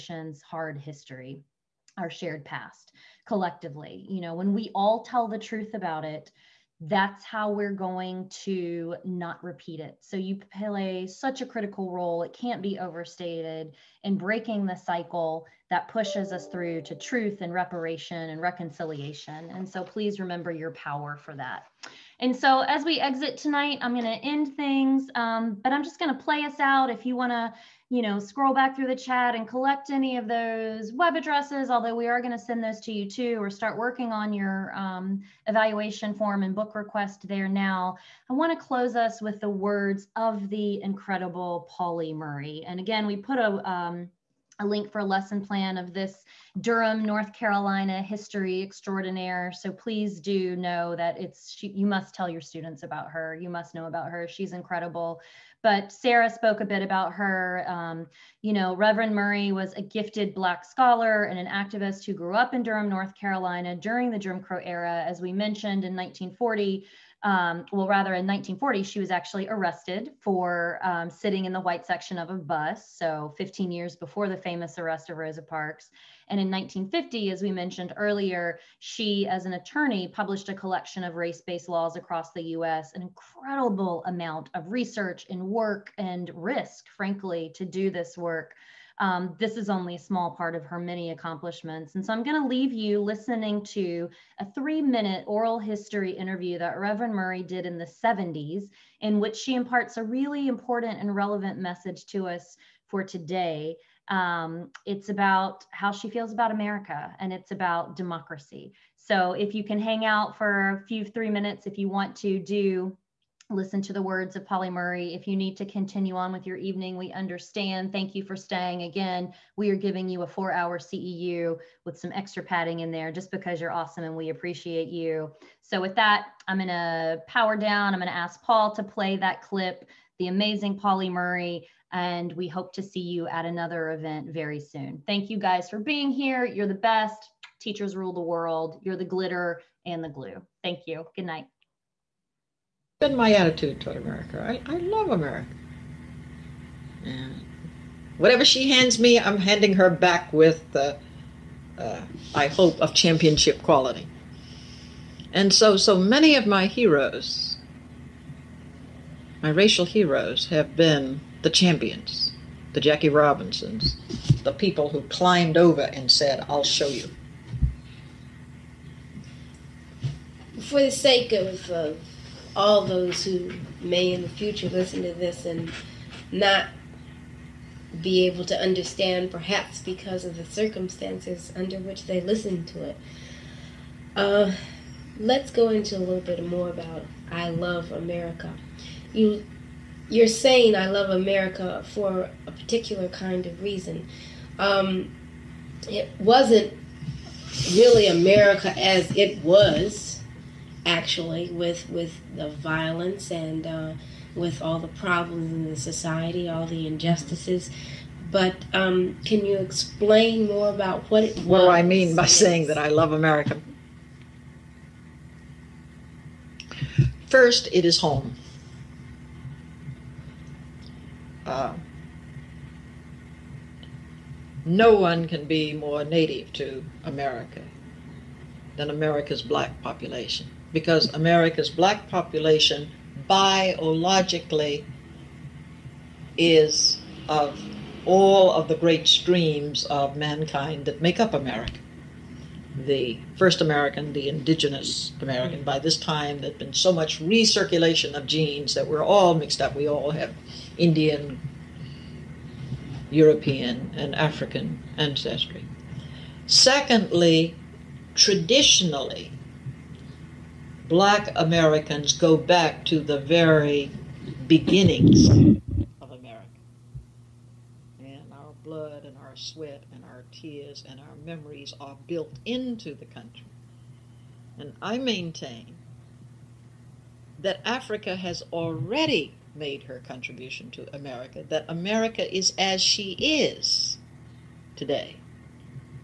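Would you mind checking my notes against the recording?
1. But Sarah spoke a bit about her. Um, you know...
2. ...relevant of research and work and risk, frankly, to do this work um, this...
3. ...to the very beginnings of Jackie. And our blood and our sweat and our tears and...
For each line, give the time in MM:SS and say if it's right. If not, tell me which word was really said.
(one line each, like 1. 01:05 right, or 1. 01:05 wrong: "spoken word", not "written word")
1. 00:55 right
2. 01:24 wrong: "amount", not "relevant"
3. 04:22 wrong: "America", not "Jackie".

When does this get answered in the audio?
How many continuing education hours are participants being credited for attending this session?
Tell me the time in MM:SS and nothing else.
02:00.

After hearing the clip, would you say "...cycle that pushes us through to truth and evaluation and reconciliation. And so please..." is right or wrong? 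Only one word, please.
wrong.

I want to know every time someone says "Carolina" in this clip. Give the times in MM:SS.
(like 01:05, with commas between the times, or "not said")
00:47, 01:03.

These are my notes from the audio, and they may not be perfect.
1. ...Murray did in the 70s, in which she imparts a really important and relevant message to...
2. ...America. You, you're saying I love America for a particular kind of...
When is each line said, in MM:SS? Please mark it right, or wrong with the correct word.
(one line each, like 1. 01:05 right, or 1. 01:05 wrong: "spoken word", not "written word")
1. 01:37 right
2. 03:07 right.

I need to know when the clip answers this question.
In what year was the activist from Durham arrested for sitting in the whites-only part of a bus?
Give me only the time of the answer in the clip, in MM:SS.
01:08.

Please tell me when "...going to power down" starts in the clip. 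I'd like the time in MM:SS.
02:06.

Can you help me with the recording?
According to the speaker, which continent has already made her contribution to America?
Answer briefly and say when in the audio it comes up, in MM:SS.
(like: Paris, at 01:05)
Africa, at 04:37.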